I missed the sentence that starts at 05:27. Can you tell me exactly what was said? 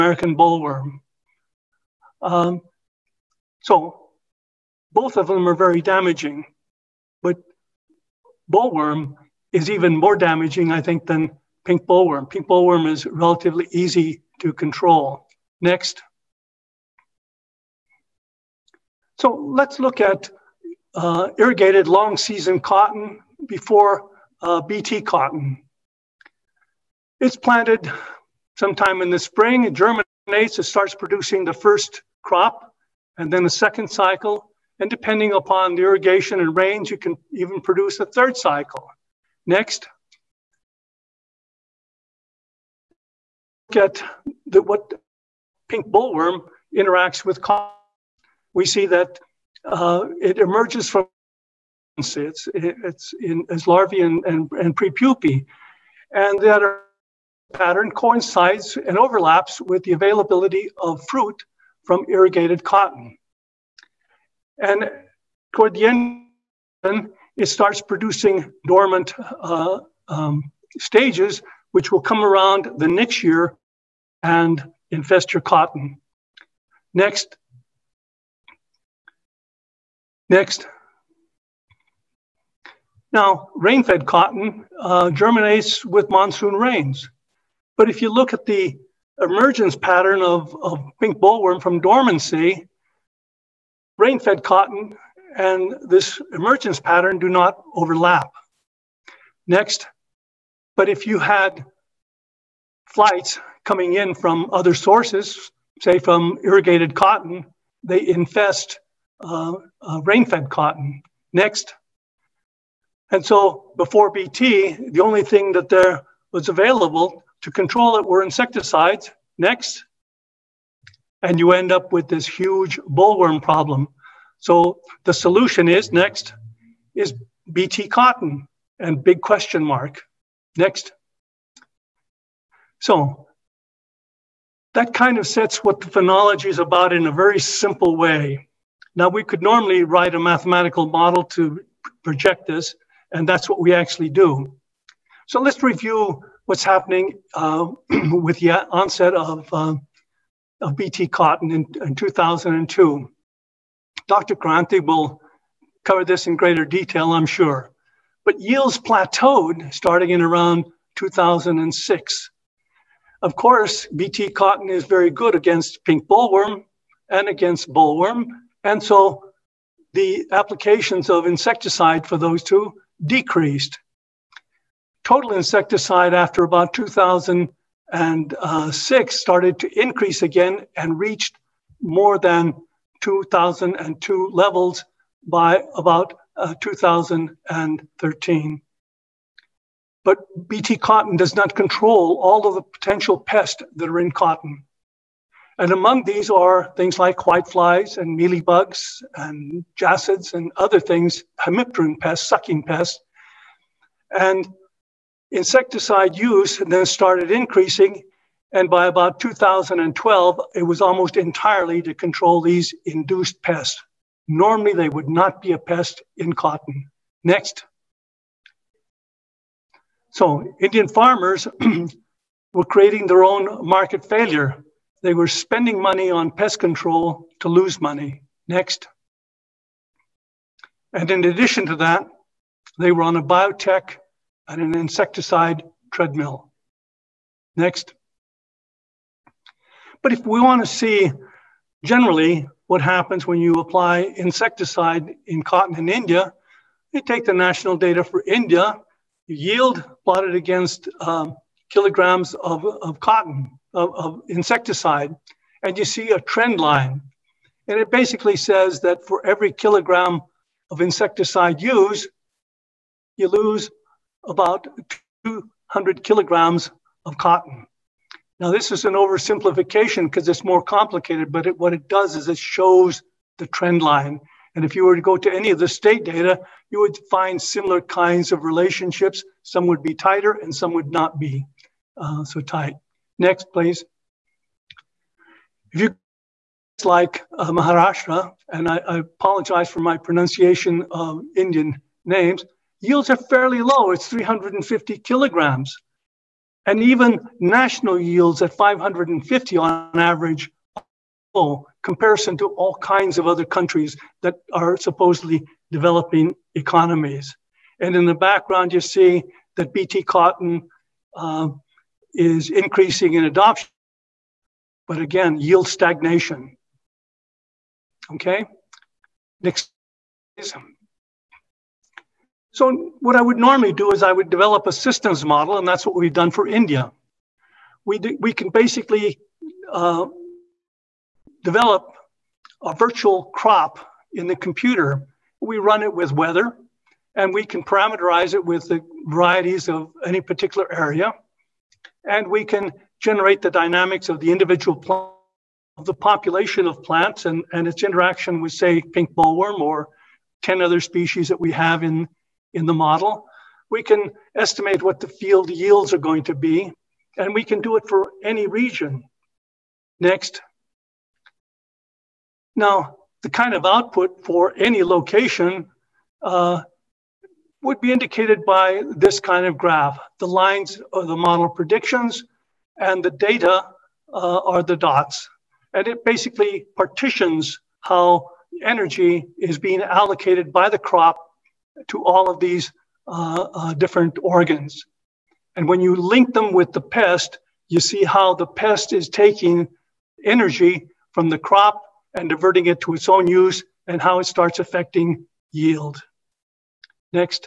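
We, do, we can basically uh, develop a virtual crop in the computer.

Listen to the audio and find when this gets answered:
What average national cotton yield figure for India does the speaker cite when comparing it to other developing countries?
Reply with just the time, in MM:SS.
04:58.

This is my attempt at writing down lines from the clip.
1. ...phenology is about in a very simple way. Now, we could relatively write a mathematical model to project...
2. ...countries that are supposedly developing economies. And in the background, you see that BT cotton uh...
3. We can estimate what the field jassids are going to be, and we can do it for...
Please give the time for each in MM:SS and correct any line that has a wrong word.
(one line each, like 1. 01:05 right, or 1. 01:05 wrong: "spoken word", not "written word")
1. 02:15 wrong: "normally", not "relatively"
2. 05:03 right
3. 05:53 wrong: "yields", not "jassids".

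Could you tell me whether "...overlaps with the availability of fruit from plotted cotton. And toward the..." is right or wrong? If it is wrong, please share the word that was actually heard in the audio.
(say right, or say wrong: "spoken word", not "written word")
wrong: "irrigated", not "plotted".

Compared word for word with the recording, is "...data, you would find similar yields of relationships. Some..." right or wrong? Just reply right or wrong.
wrong.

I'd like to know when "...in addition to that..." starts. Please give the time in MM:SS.
03:51.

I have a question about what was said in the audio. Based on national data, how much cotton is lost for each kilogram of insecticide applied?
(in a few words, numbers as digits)
200 kilograms.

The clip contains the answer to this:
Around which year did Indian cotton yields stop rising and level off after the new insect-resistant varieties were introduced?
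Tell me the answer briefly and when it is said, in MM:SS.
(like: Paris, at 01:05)
2006, at 02:40.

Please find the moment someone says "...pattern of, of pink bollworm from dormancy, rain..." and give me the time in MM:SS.
01:29.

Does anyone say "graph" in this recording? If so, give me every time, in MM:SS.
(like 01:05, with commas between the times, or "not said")
06:09.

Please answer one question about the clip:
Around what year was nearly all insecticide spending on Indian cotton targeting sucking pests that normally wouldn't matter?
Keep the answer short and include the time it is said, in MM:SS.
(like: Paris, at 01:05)
2012, at 03:29.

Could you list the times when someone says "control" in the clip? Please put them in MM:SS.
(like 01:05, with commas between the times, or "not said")
00:14, 01:57, 03:11, 03:31, 03:46.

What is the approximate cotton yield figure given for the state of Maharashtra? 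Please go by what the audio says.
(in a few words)
350 kilograms.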